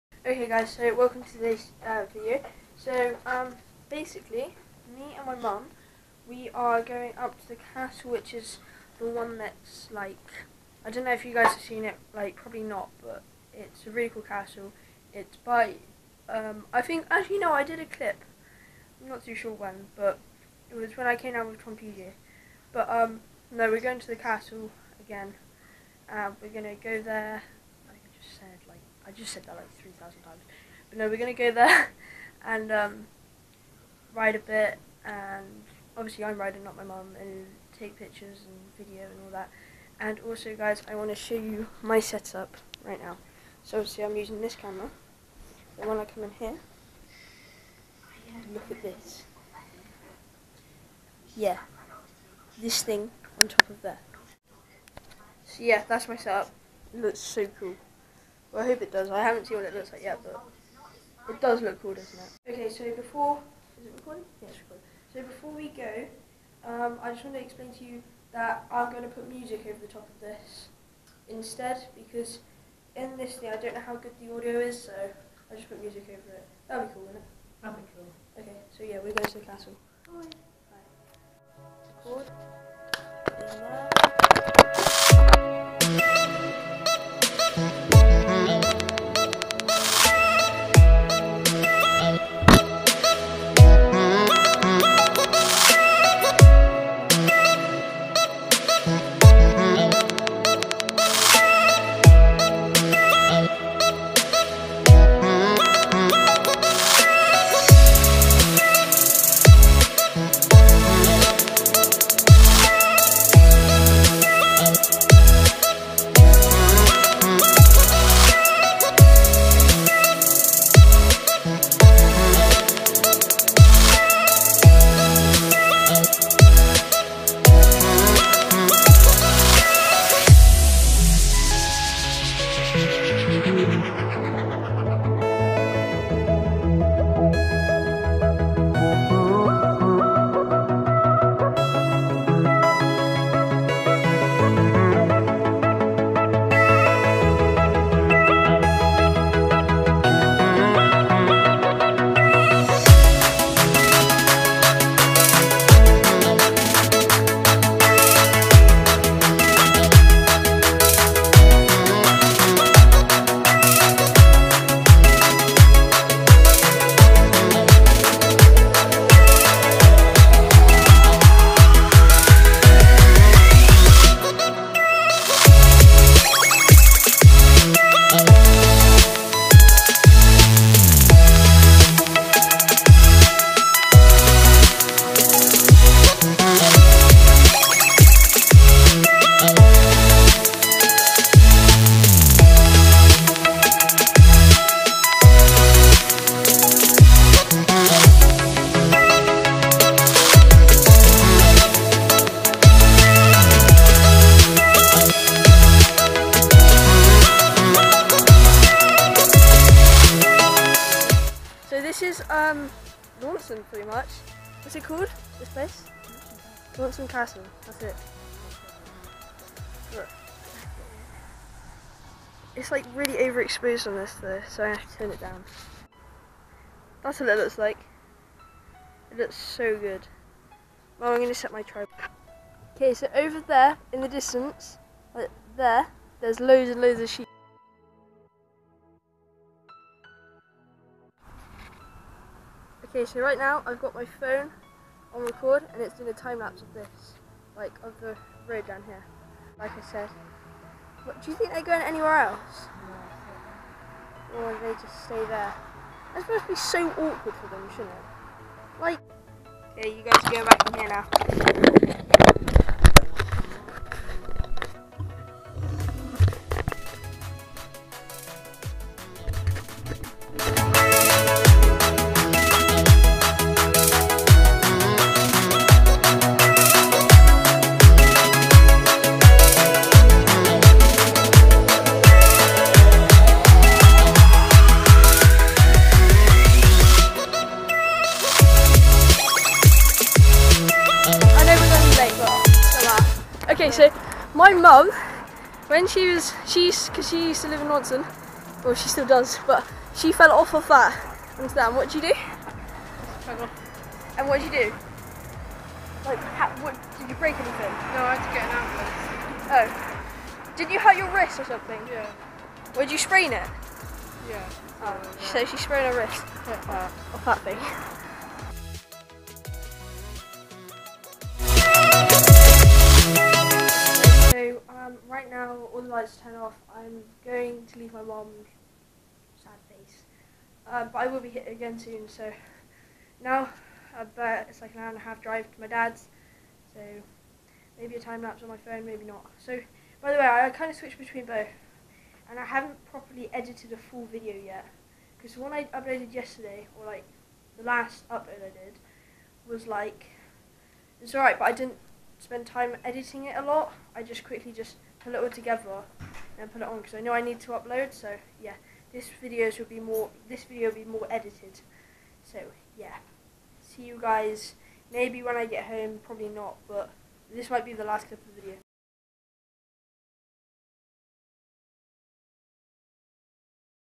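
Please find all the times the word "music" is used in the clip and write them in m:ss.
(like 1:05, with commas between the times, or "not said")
1:09, 1:15.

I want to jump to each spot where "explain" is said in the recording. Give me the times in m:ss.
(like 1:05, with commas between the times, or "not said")
1:07.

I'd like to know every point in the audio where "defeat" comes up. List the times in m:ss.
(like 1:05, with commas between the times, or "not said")
not said.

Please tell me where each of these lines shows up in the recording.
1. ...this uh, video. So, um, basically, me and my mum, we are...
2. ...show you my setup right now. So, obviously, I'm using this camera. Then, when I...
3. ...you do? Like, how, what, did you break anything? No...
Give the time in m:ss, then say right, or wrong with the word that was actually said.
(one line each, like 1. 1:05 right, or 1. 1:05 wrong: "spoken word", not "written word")
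1. 0:01 right
2. 0:41 right
3. 5:04 right.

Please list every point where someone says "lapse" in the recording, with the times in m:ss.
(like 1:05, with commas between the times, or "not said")
4:06, 5:38.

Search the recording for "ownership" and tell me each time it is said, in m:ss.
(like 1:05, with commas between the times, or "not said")
not said.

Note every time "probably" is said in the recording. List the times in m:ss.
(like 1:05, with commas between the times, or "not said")
0:12, 6:06.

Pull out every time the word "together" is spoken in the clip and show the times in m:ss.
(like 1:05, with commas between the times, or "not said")
5:55.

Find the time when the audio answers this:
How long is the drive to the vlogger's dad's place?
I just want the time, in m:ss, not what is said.
5:34.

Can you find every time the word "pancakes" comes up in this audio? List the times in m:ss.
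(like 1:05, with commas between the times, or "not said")
not said.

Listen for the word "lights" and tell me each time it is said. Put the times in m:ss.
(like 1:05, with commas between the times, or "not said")
5:25.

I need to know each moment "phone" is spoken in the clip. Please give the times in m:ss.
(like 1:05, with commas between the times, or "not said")
4:04, 5:38.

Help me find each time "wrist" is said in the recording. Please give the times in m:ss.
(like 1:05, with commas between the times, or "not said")
5:11, 5:16.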